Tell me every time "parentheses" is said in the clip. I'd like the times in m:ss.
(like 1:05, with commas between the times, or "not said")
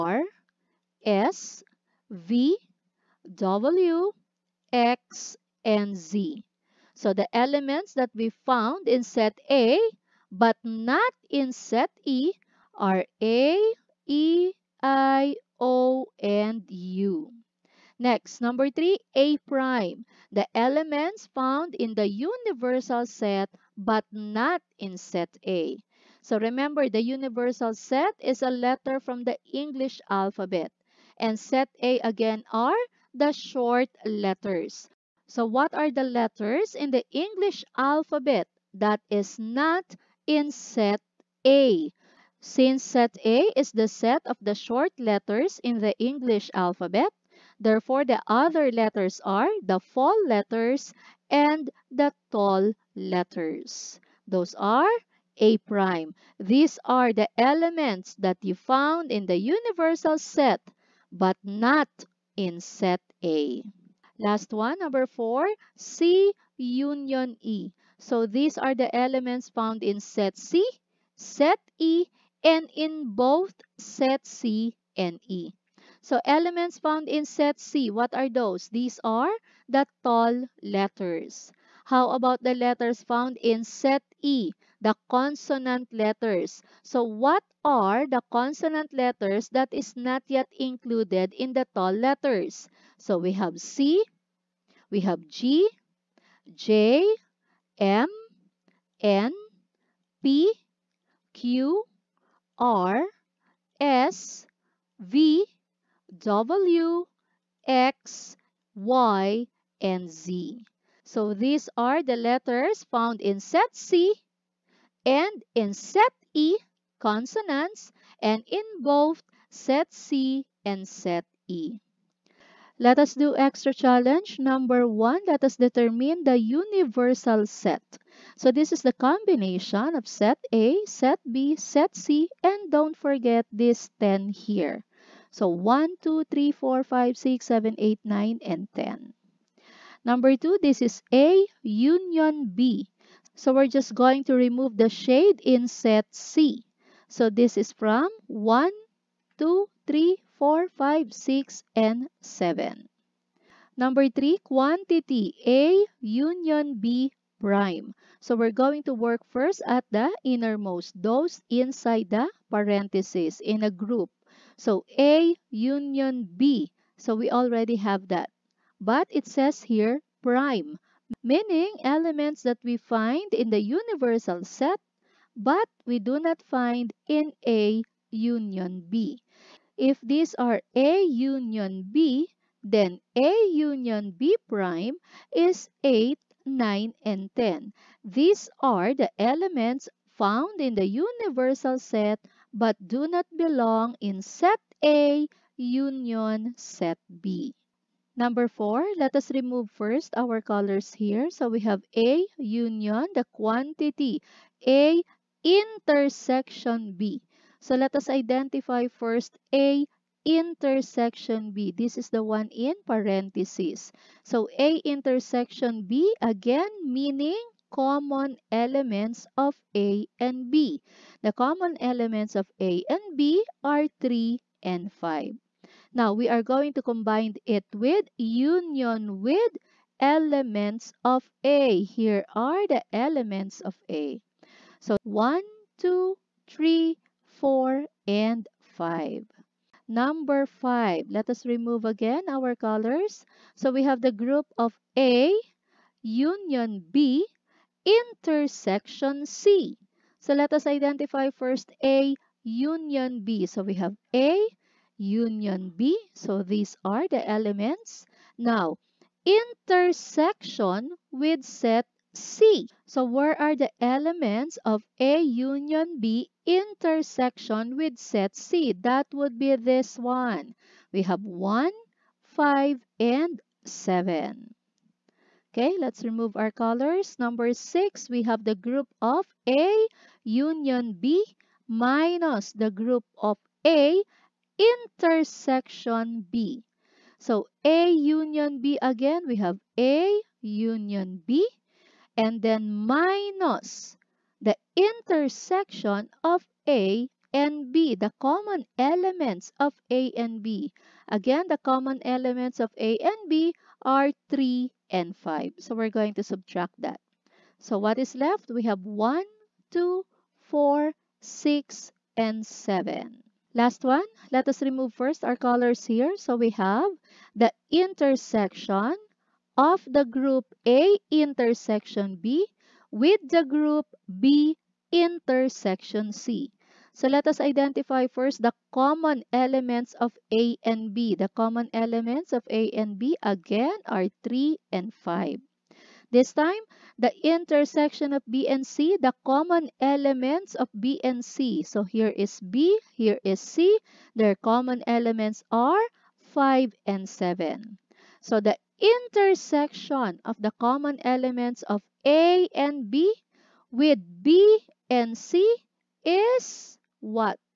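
2:42, 3:32.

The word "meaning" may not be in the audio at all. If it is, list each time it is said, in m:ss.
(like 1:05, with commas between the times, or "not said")
2:51, 3:36.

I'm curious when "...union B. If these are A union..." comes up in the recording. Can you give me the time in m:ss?
2:58.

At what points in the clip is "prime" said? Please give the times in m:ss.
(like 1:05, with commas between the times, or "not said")
0:19, 0:55, 2:37, 2:50, 3:04.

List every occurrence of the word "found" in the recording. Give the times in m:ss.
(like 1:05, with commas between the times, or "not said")
0:08, 0:21, 0:58, 1:09, 1:16, 1:23, 1:52, 3:10.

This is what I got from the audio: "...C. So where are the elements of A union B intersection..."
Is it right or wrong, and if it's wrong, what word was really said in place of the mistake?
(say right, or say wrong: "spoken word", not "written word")
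right.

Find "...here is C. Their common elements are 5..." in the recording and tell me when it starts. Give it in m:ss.
5:42.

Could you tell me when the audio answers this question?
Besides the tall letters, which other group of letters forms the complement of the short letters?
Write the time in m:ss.
0:49.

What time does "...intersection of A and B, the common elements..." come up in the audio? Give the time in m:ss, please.
4:54.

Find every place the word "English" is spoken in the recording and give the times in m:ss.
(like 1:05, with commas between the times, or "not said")
0:29, 0:37, 0:46.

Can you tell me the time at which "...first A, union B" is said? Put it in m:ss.
4:11.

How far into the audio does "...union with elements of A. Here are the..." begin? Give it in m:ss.
3:48.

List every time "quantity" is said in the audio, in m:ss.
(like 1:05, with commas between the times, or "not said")
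2:34, 3:23.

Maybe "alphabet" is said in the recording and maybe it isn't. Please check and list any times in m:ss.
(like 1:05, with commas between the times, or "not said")
0:30, 0:37, 0:46.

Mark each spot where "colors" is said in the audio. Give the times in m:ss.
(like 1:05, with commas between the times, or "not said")
3:20, 4:02, 4:36, 5:15.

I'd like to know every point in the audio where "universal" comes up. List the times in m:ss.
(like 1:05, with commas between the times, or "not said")
0:22, 0:27, 0:59, 2:06, 2:53, 3:10.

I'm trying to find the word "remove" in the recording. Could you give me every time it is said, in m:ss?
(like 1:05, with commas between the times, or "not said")
2:24, 3:19, 4:01, 4:36, 5:14.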